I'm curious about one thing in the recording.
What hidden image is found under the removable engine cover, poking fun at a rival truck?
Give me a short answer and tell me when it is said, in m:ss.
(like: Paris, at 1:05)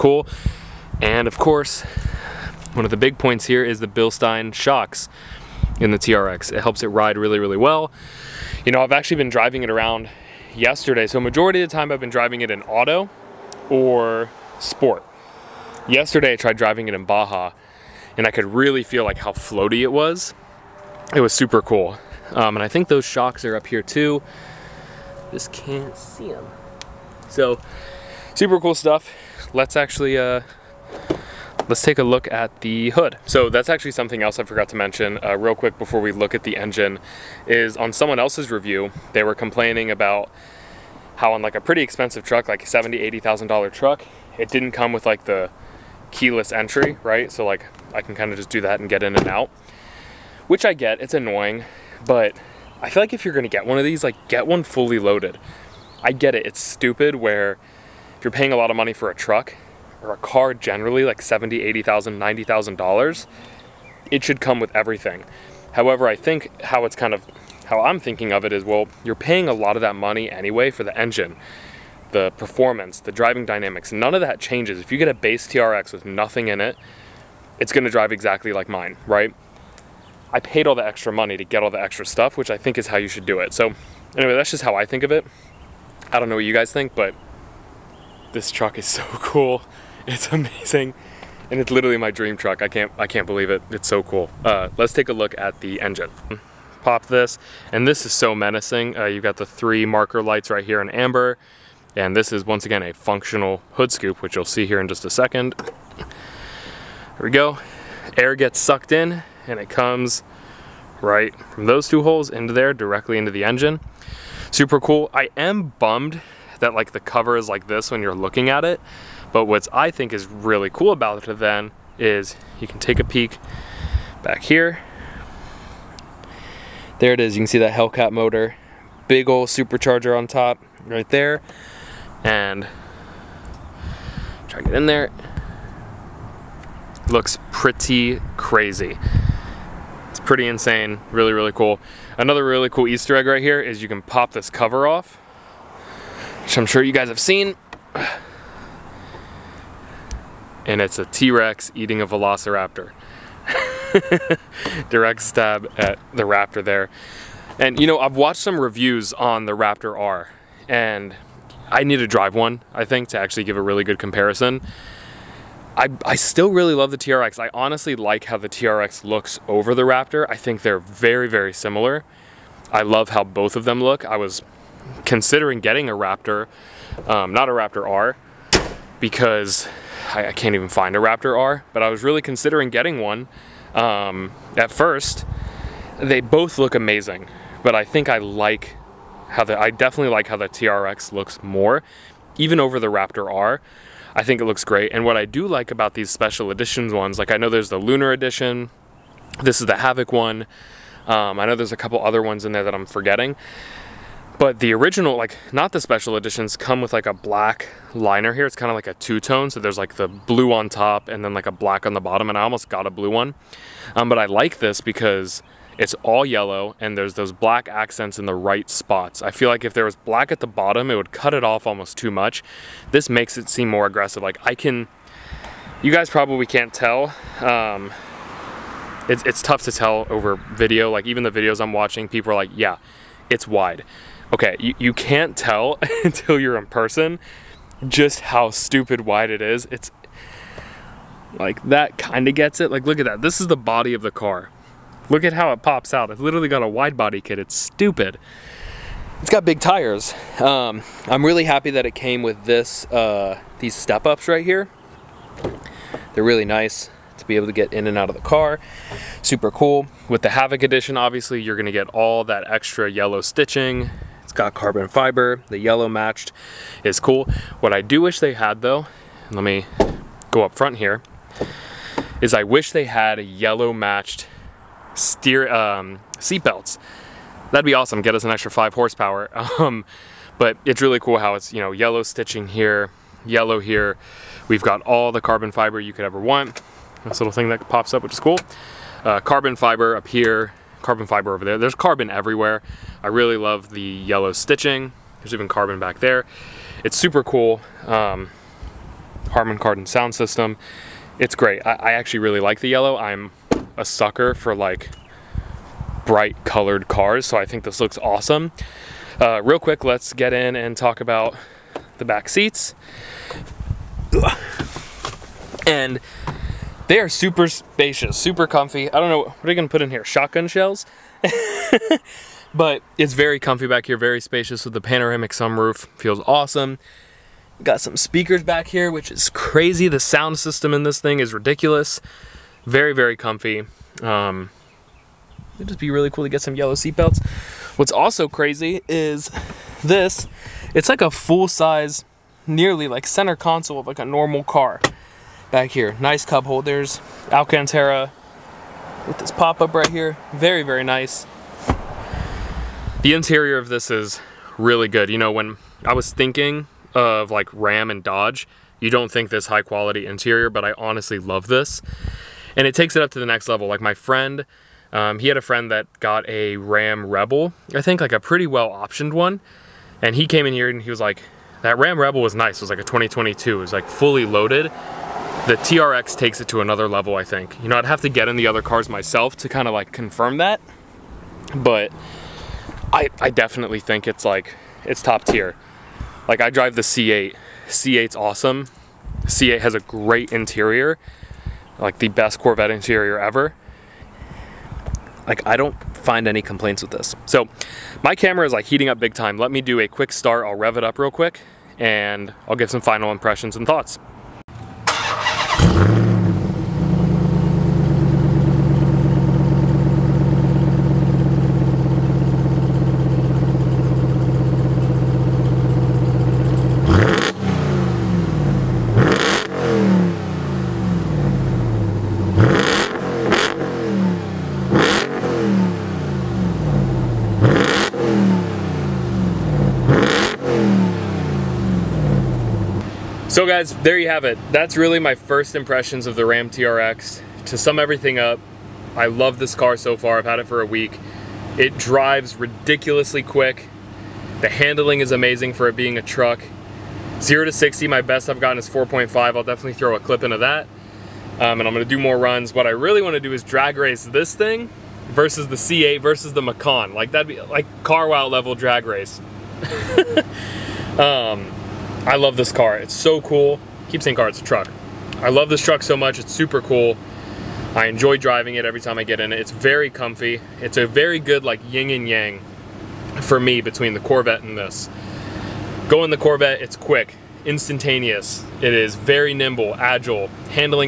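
T-Rex eating a Velociraptor, at 2:31.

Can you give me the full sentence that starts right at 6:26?
Like I drive the C8, C8's awesome.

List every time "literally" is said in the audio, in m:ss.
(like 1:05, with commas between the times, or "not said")
1:31, 4:06.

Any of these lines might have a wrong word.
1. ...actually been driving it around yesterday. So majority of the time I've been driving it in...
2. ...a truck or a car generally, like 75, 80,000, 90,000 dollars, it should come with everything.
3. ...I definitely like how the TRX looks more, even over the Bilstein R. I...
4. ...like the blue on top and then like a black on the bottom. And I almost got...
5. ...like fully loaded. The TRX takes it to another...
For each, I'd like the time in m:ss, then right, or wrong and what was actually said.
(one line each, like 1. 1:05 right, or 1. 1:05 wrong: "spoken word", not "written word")
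1. 0:08 right
2. 0:59 wrong: "70", not "75"
3. 3:09 wrong: "Raptor", not "Bilstein"
4. 3:29 right
5. 6:13 right.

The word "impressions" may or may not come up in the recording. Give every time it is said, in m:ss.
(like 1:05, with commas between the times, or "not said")
6:43, 7:15.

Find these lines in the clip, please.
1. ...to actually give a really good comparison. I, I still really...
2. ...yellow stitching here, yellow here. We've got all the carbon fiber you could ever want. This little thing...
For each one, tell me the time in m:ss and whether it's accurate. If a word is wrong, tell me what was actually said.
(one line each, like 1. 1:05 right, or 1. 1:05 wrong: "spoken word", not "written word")
1. 2:43 right
2. 4:41 right.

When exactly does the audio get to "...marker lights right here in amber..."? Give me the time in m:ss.
1:39.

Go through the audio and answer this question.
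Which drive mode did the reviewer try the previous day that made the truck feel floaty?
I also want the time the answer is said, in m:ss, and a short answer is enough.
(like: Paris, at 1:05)
Baja, at 0:17.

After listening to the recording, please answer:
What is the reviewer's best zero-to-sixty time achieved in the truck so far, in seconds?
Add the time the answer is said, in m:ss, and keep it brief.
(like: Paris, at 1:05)
4.5, at 7:28.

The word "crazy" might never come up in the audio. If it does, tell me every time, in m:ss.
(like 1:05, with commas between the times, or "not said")
2:18, 5:29, 5:38.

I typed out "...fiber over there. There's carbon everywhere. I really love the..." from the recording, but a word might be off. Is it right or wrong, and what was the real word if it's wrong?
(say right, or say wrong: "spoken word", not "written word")
right.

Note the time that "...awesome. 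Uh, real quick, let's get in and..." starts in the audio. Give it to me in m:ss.
5:07.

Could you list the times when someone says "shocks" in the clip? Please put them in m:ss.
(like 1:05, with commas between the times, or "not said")
0:04, 0:23.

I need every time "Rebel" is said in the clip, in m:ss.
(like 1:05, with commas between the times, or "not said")
6:07, 6:11.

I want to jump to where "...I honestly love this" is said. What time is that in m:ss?
6:00.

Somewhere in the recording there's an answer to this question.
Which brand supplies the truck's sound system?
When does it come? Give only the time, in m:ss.
4:59.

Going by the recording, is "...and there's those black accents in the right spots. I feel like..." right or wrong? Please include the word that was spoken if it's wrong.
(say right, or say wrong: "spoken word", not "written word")
right.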